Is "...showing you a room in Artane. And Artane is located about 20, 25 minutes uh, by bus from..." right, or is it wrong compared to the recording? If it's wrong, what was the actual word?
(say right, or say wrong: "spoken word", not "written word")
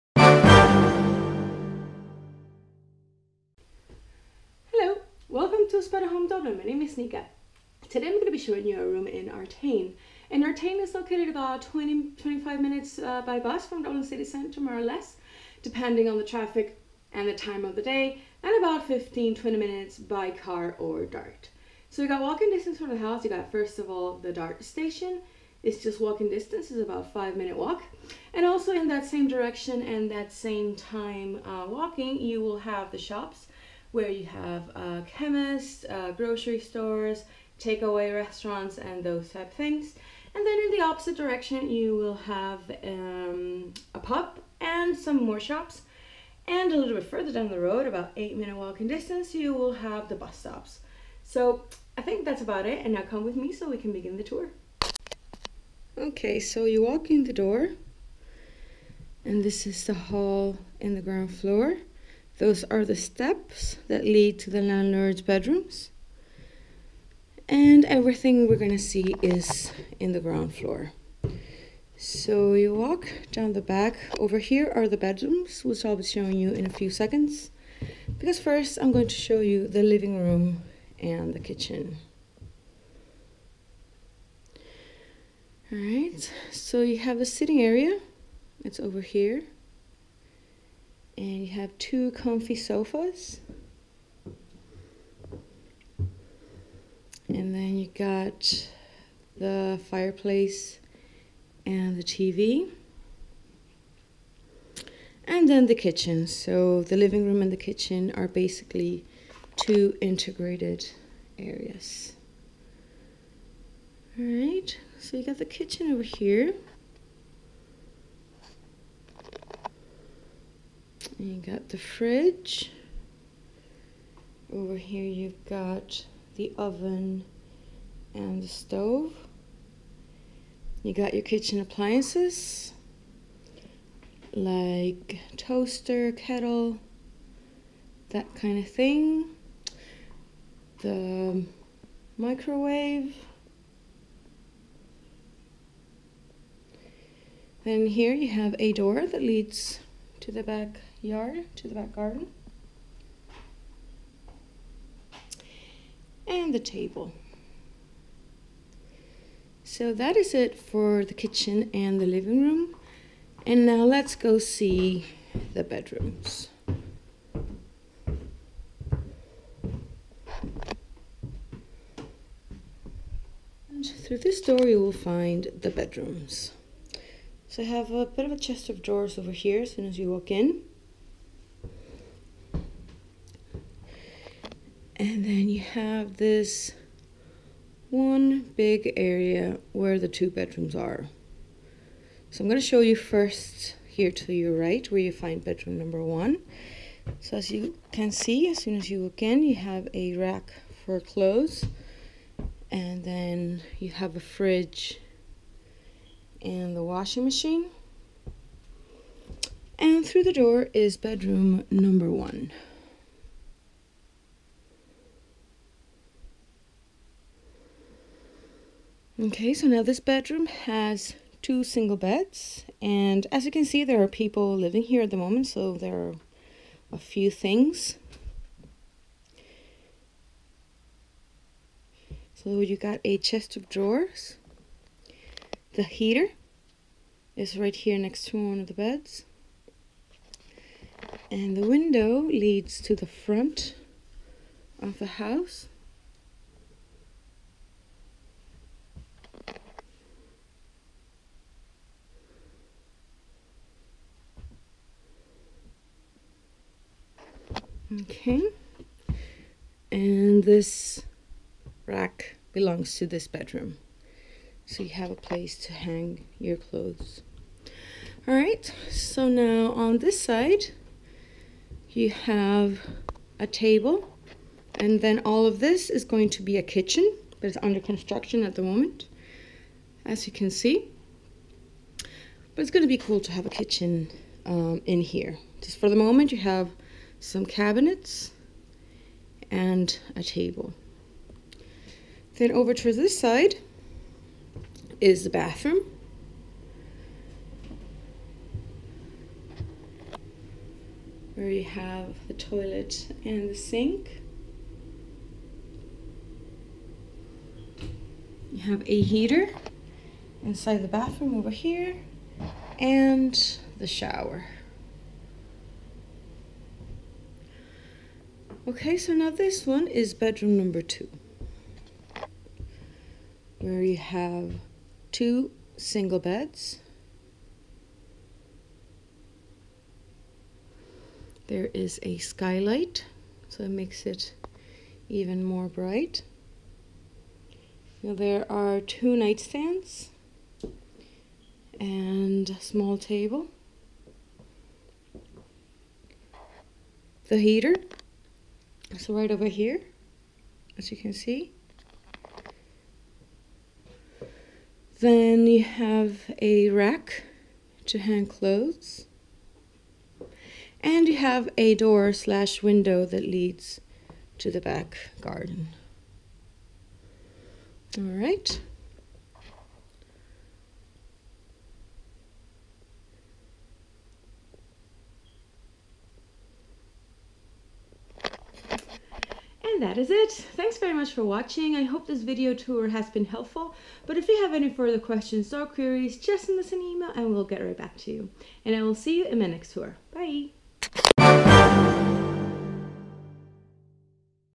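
right.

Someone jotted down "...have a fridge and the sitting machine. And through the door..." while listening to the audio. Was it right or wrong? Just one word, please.
wrong.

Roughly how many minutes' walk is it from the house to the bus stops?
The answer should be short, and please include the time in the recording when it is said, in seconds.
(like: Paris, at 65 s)
8, at 48 s.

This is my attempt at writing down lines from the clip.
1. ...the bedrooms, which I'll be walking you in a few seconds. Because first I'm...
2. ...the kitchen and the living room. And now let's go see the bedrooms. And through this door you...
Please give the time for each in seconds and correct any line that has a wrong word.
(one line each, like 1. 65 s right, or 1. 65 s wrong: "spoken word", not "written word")
1. 74 s wrong: "showing", not "walking"
2. 161 s right.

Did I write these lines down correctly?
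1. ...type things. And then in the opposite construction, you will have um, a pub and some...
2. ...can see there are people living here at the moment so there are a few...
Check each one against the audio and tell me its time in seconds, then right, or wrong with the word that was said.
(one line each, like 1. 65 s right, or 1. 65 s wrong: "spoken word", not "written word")
1. 39 s wrong: "direction", not "construction"
2. 223 s right.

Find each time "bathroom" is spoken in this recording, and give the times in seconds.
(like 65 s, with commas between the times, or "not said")
295 s, 310 s.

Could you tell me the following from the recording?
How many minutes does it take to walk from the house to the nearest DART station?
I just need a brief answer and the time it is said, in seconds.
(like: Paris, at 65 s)
5, at 27 s.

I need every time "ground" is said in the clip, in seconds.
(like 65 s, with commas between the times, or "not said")
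61 s, 70 s.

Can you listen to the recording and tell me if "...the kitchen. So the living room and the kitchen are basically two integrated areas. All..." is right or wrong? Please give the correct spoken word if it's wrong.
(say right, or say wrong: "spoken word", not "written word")
right.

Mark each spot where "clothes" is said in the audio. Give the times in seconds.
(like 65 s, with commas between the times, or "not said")
200 s, 266 s, 358 s.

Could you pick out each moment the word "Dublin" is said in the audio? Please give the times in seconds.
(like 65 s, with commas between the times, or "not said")
6 s, 13 s.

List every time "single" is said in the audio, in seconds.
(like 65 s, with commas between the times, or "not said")
221 s, 325 s.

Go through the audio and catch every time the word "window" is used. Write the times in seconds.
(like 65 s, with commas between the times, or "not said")
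241 s, 362 s.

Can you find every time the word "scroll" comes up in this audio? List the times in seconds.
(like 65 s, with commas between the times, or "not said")
not said.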